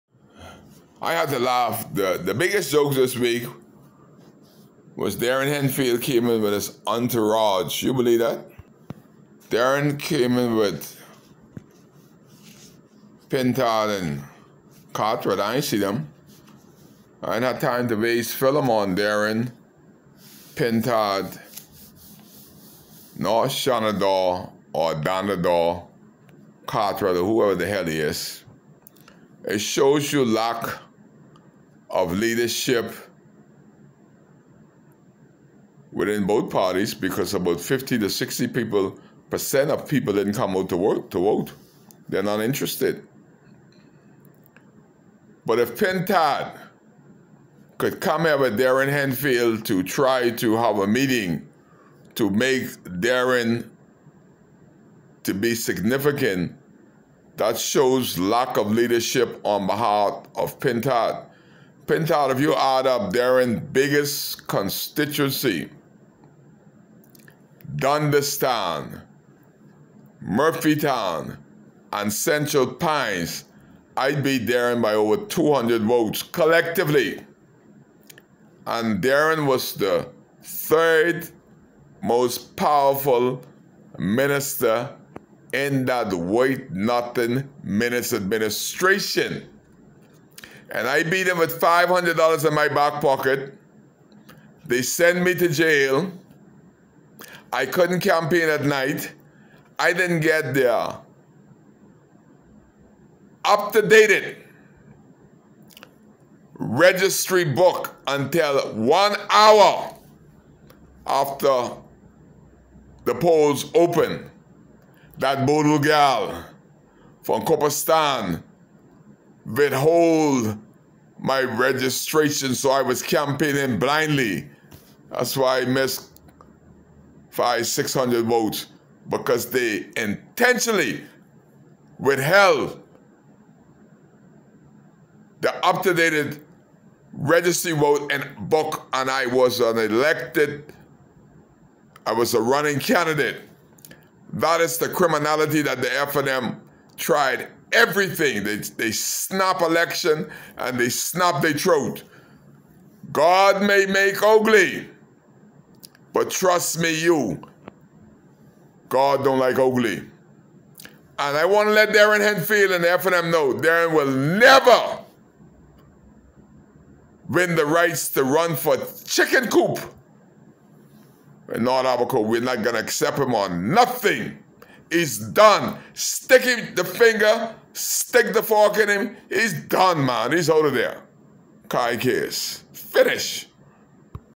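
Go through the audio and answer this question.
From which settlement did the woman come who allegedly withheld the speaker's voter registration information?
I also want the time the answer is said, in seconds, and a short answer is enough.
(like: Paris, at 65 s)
Cooper's Town, at 117 s.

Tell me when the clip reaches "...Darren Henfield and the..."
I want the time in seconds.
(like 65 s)
161 s.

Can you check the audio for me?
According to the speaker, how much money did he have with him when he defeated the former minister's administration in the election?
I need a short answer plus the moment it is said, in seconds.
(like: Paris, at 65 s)
$500, at 91 s.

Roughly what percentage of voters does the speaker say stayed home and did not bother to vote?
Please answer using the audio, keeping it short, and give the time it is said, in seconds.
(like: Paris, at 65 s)
50 to 60 percent, at 37 s.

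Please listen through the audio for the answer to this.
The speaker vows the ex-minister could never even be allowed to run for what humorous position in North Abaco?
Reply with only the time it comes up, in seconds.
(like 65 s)
169 s.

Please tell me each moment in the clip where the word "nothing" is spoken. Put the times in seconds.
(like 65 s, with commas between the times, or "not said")
86 s, 173 s.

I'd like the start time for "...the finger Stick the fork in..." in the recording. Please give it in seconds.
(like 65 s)
176 s.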